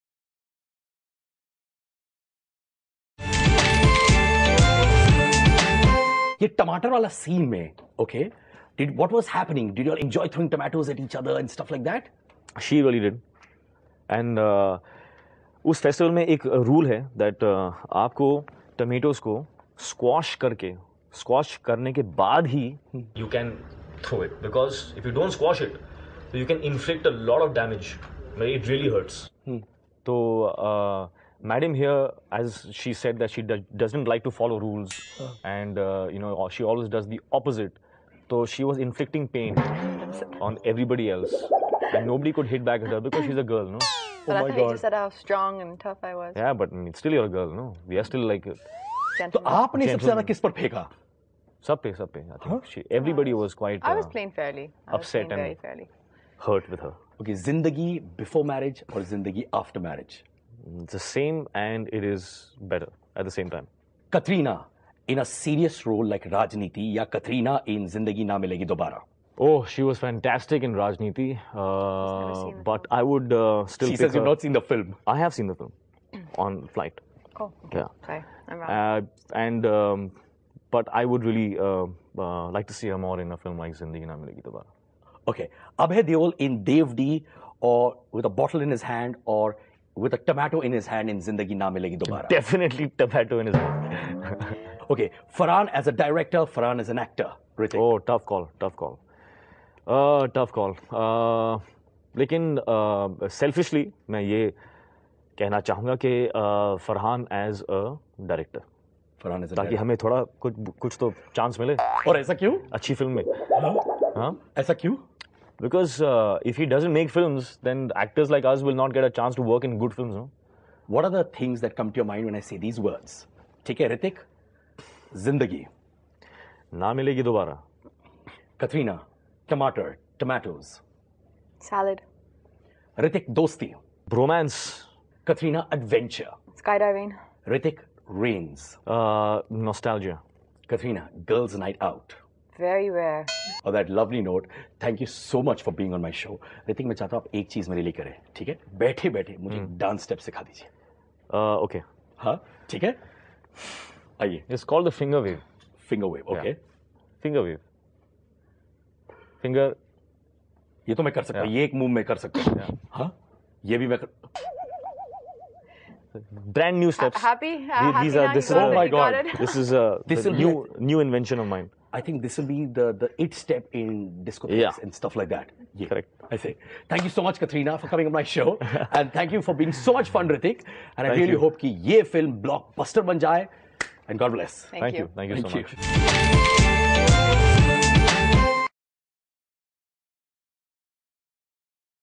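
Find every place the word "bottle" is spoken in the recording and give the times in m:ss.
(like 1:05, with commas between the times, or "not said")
1:28.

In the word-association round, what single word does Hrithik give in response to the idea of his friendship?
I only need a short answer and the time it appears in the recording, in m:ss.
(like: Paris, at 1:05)
Bromance, at 2:14.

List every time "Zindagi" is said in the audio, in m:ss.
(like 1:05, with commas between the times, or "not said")
1:07, 1:23, 1:31, 2:05.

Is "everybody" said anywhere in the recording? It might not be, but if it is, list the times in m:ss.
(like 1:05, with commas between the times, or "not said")
0:40, 0:52.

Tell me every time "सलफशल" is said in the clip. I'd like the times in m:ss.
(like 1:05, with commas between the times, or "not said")
1:43.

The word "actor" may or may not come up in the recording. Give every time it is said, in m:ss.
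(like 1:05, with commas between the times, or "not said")
1:36, 1:57.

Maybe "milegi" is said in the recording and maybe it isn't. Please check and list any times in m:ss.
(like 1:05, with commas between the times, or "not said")
1:08, 1:24, 1:31, 2:06.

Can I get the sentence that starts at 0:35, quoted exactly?
and uh, you know she always does the opposite.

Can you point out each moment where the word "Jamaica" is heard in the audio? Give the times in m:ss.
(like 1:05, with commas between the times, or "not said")
not said.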